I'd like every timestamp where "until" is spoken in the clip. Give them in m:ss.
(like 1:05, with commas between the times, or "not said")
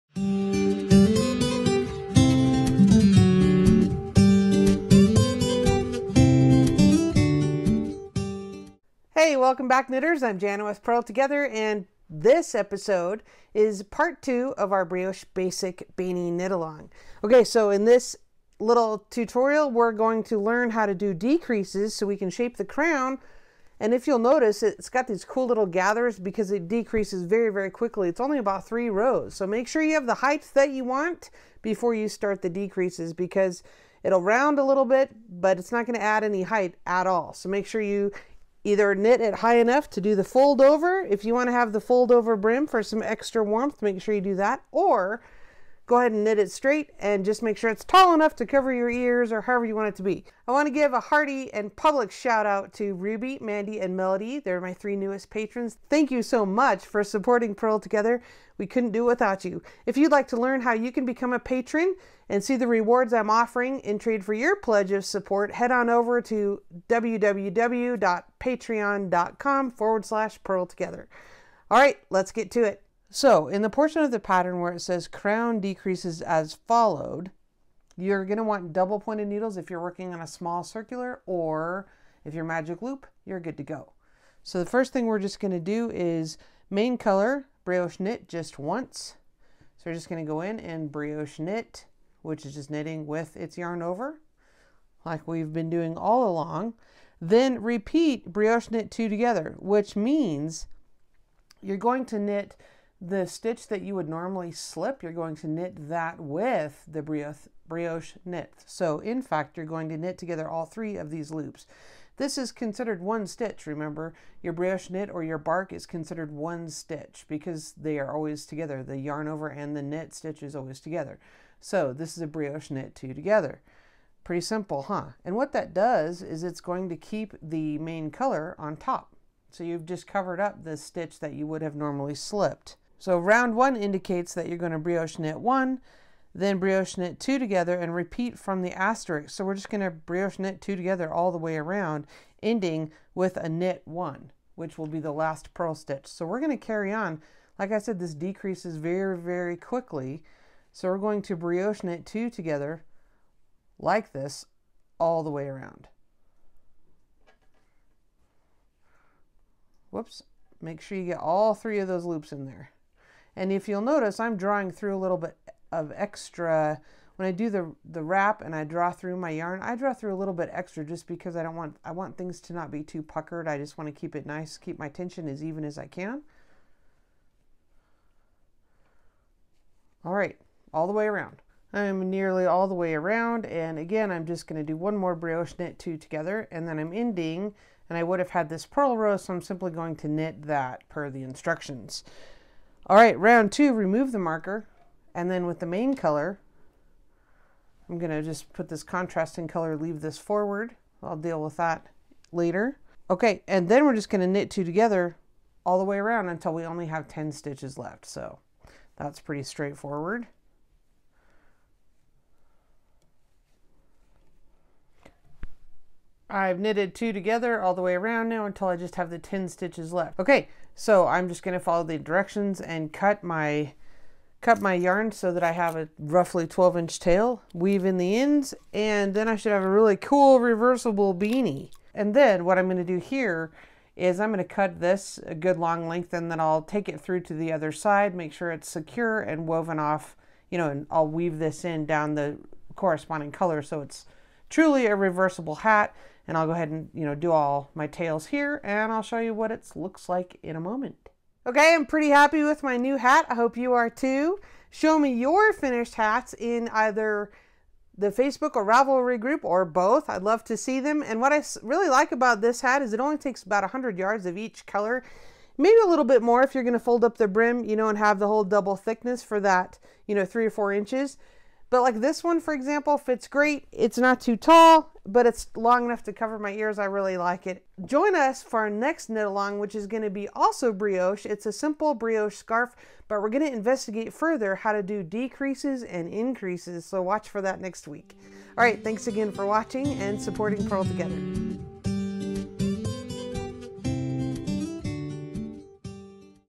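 3:26, 3:38.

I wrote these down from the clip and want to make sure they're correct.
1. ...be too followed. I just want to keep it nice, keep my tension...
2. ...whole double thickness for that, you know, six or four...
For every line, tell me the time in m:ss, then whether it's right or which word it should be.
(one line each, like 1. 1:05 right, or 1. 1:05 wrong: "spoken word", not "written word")
1. 2:52 wrong: "puckered", not "followed"
2. 4:28 wrong: "three", not "six".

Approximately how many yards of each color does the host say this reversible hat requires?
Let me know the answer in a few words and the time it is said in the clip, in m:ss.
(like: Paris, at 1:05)
100 yards, at 4:23.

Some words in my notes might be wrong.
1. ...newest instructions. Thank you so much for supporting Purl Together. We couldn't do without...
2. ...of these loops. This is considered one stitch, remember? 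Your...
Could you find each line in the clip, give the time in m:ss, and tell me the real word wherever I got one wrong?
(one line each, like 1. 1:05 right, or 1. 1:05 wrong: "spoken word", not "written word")
1. 0:54 wrong: "patrons", not "instructions"
2. 1:50 right.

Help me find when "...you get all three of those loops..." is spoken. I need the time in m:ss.
2:40.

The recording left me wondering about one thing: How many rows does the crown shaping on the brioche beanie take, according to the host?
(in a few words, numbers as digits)
3.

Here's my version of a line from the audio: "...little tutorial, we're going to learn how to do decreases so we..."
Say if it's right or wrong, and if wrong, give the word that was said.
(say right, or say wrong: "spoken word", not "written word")
right.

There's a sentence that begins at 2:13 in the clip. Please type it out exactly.
So round one indicates that you're going to brioche knit one, then brioche knit two together and repeat from the asterisk.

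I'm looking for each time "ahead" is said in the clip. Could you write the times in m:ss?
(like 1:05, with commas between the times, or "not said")
0:45, 4:06.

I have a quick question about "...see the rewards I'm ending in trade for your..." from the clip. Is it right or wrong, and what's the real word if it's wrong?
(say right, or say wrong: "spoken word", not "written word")
wrong: "offering", not "ending".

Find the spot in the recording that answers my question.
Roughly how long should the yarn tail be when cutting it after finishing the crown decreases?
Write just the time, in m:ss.
3:46.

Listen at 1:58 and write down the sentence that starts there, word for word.
The yarn over and the knit stitch is always together.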